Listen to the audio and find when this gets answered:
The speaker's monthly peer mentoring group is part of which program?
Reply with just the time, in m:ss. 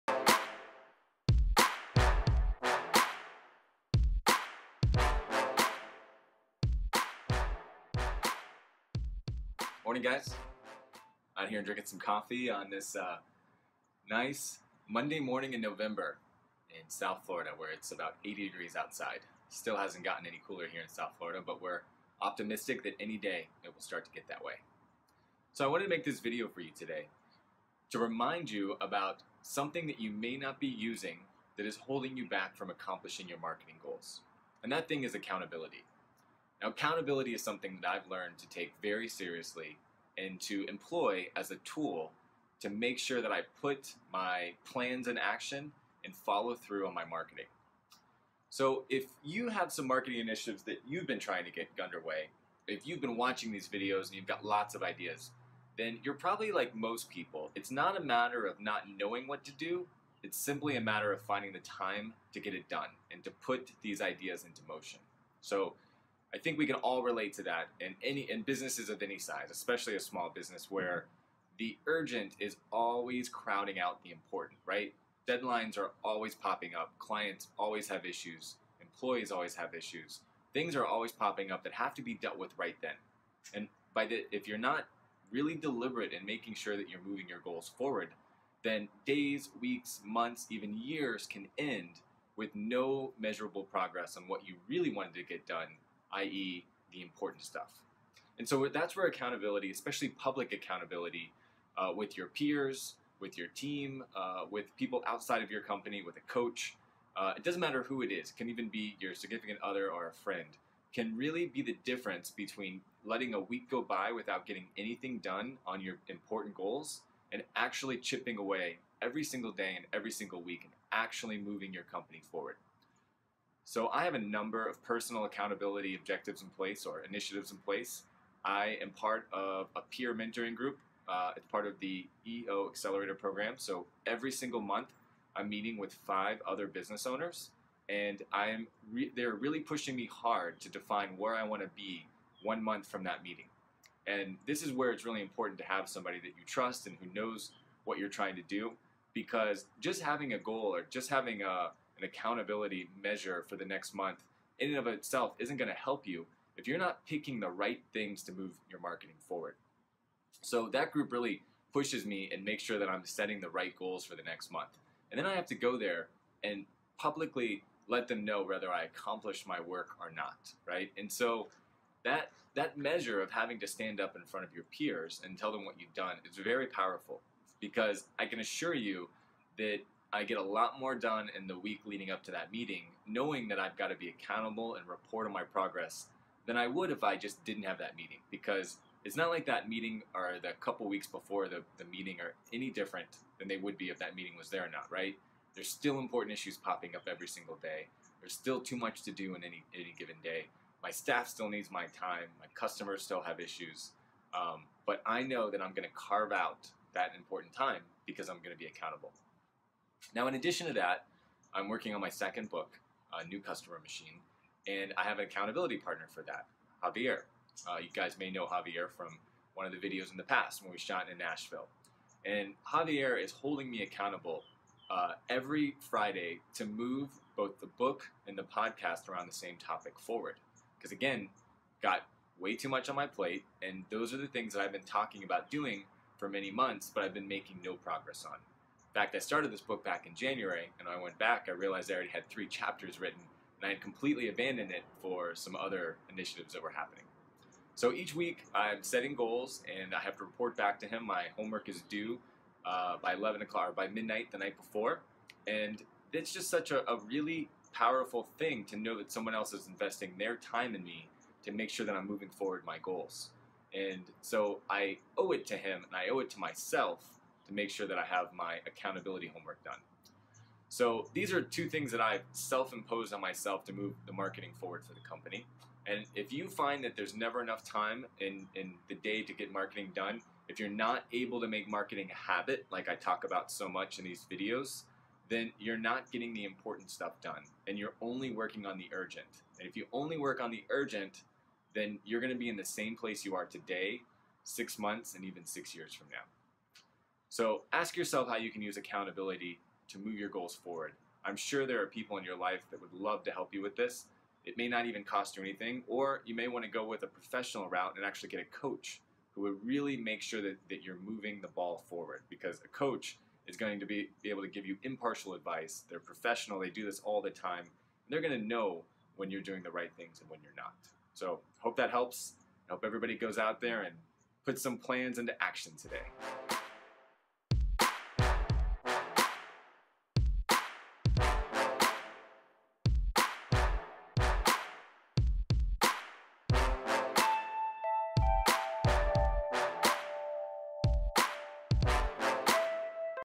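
2:12.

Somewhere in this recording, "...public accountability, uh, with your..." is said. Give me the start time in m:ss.
1:40.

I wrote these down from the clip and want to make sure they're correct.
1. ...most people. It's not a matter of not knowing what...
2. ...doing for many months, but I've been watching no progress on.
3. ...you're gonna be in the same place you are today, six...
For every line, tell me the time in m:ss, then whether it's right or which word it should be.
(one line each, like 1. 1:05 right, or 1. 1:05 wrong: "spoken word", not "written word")
1. 0:56 right
2. 3:55 wrong: "making", not "watching"
3. 4:52 right.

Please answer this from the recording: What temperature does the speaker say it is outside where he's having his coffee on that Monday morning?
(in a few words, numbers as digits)
80 degrees.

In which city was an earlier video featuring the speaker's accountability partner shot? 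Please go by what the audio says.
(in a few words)
Nashville.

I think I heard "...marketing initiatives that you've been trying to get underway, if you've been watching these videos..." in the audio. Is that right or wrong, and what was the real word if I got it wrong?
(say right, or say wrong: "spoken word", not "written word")
right.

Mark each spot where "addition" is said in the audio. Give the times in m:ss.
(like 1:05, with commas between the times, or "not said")
3:30.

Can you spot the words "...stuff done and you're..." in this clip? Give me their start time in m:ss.
4:46.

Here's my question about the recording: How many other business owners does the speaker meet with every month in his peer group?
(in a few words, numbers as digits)
5.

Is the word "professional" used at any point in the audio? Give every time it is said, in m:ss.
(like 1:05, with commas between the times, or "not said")
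5:07, 5:15.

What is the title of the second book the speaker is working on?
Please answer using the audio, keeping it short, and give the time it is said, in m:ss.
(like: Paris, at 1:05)
New Customer Machine, at 3:33.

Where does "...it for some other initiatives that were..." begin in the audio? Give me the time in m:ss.
4:04.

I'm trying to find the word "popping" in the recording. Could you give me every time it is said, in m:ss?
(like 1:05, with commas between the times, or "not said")
1:16, 1:21, 3:16.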